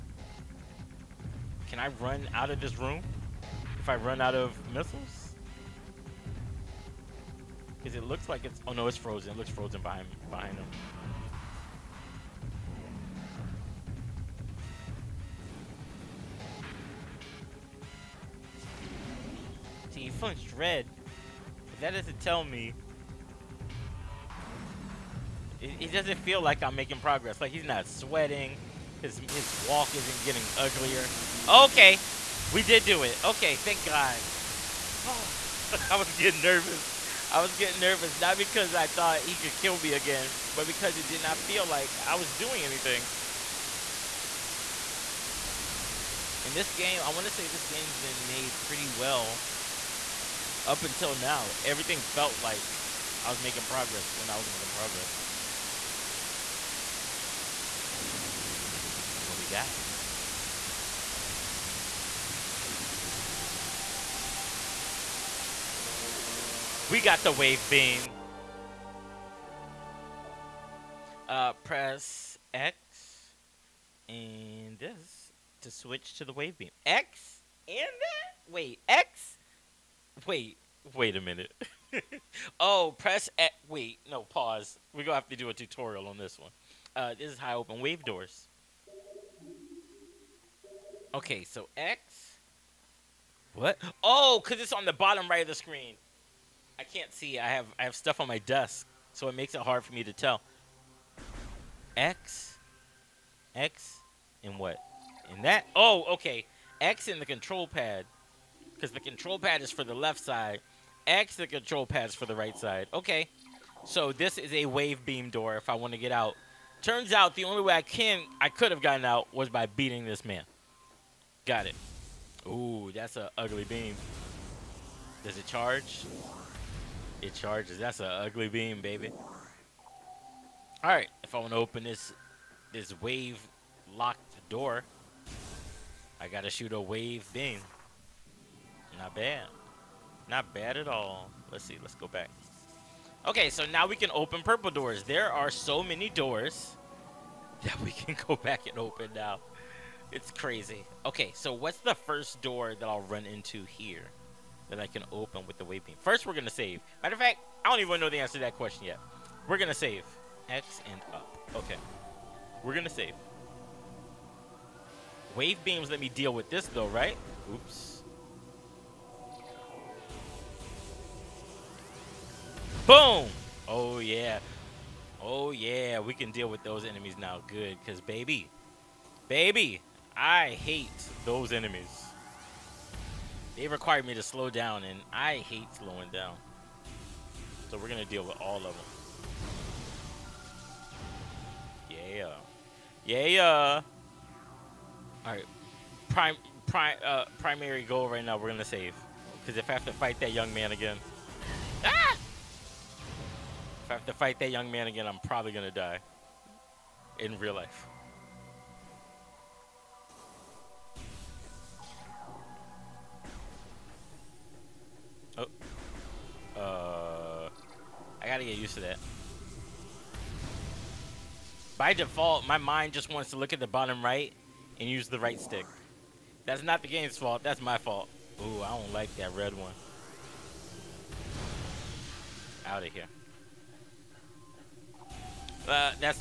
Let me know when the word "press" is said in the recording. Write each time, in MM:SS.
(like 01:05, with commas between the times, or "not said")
01:11, 01:22.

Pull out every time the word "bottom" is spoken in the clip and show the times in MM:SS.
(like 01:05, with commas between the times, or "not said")
01:34, 03:43.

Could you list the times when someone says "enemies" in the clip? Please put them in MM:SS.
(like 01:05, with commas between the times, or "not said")
02:56, 03:01.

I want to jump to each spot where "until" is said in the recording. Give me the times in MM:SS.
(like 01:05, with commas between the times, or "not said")
00:50.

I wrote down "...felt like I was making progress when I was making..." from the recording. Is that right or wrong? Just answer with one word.
right.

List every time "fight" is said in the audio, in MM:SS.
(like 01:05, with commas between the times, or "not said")
03:19, 03:24.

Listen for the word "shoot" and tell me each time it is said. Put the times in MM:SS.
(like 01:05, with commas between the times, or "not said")
02:16.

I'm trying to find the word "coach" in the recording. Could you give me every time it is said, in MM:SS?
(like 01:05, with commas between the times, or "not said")
not said.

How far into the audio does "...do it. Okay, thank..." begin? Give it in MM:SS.
00:32.